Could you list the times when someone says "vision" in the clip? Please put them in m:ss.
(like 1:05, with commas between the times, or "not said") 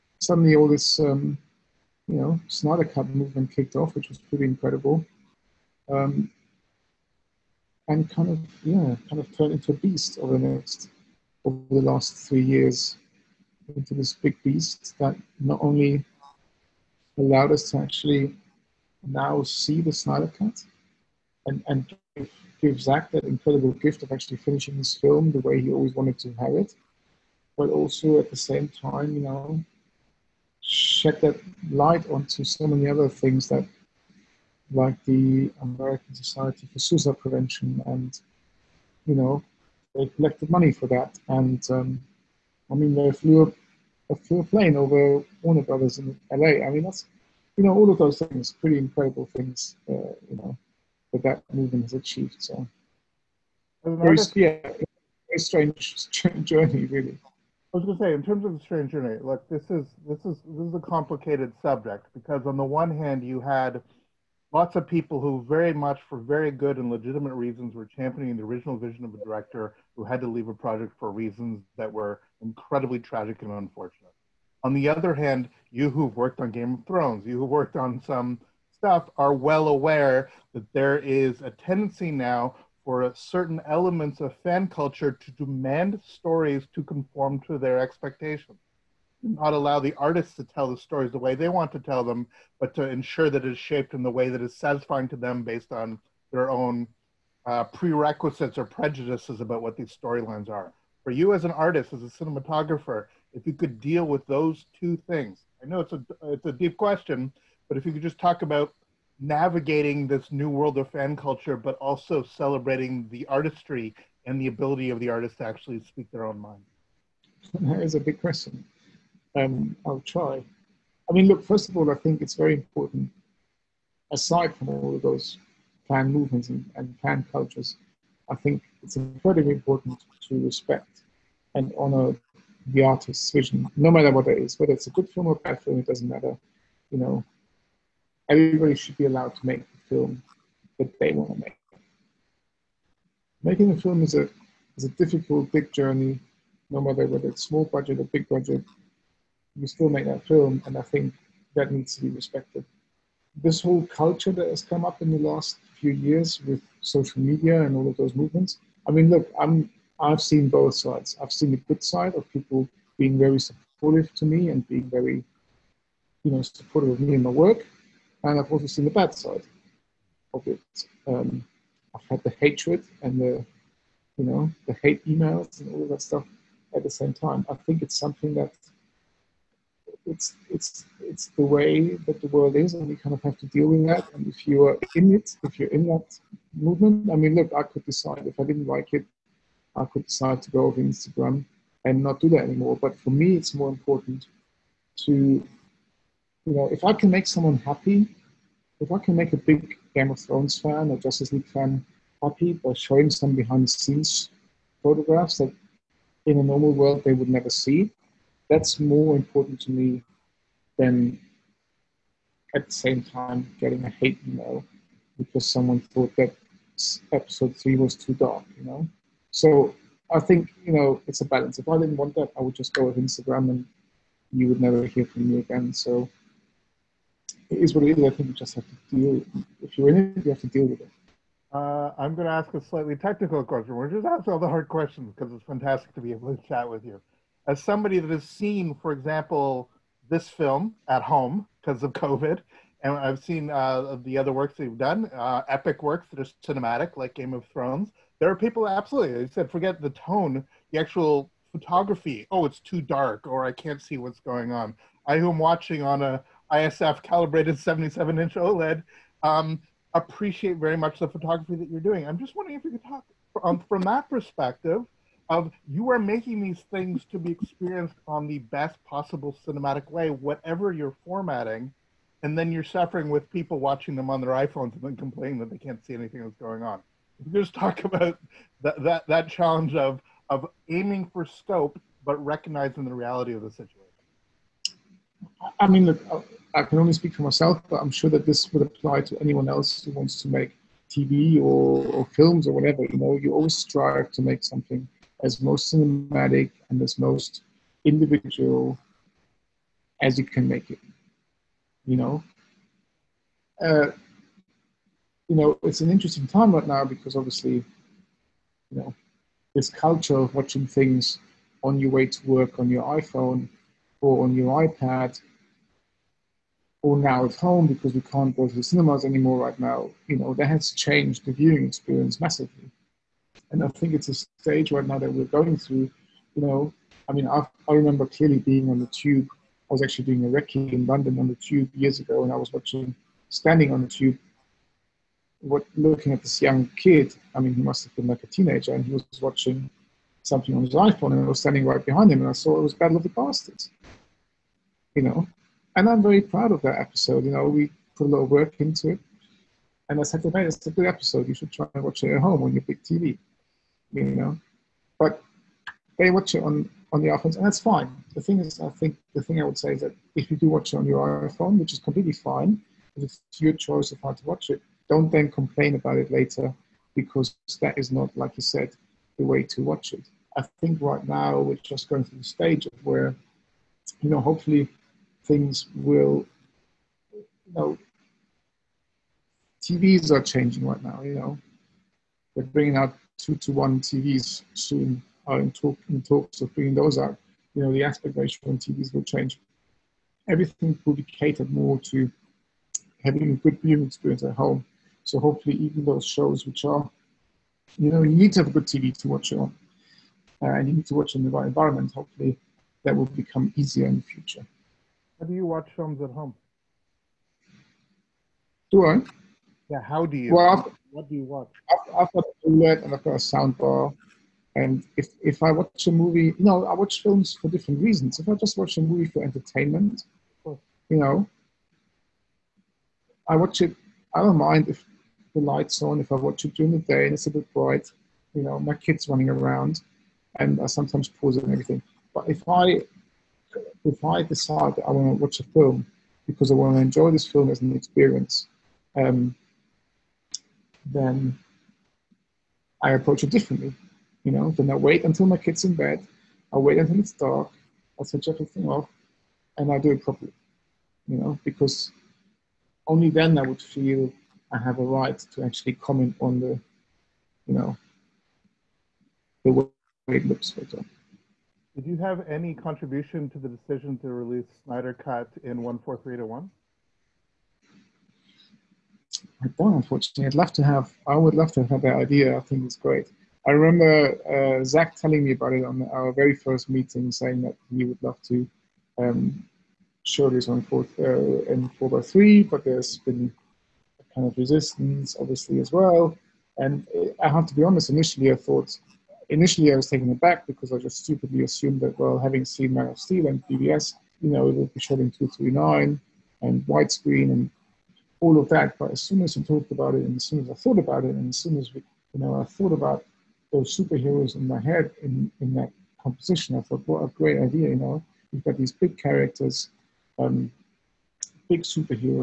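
1:08, 2:13.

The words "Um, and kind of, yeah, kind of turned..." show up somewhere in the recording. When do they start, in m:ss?
0:05.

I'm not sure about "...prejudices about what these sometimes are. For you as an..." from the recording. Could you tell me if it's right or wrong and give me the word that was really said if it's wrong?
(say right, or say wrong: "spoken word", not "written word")
wrong: "storylines", not "sometimes".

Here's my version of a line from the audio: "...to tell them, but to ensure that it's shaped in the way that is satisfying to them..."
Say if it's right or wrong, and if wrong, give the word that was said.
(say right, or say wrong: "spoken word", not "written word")
right.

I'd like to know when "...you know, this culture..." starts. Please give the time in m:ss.
5:08.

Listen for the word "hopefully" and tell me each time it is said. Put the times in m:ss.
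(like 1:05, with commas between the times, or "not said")
6:14, 6:35, 6:41.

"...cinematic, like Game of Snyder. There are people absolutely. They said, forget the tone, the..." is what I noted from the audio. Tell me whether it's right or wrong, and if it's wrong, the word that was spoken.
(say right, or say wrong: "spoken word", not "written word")
wrong: "Thrones", not "Snyder".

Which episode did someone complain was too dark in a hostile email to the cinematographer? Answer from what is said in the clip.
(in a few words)
Episode three.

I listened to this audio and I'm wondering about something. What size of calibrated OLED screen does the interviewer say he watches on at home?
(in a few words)
77 inch.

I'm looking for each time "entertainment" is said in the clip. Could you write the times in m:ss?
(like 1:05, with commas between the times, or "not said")
6:59.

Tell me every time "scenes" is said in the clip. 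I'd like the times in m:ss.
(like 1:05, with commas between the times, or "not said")
3:23.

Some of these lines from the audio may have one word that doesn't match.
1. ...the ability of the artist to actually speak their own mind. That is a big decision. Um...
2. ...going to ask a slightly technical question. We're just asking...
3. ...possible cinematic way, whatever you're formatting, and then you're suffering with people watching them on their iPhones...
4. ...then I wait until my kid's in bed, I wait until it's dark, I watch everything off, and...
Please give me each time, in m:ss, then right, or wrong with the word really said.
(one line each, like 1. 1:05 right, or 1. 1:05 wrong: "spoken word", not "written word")
1. 1:54 wrong: "question", not "decision"
2. 3:52 right
3. 4:28 right
4. 7:24 wrong: "switch", not "watch".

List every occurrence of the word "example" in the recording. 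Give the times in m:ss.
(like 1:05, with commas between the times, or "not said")
3:58, 7:40.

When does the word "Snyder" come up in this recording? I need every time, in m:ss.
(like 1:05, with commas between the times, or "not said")
0:02, 0:19, 7:44.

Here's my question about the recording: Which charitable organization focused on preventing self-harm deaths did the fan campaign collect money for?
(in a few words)
American Society for Suicide Prevention.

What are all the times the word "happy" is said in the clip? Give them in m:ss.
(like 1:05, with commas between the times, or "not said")
3:17, 3:22.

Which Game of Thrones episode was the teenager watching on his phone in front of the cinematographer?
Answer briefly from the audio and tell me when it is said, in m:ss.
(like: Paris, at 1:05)
Battle of the Bastards, at 5:42.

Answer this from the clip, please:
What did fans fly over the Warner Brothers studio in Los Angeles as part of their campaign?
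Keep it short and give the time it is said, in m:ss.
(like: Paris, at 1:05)
A plane, at 0:44.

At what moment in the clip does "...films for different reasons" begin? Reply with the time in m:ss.
6:57.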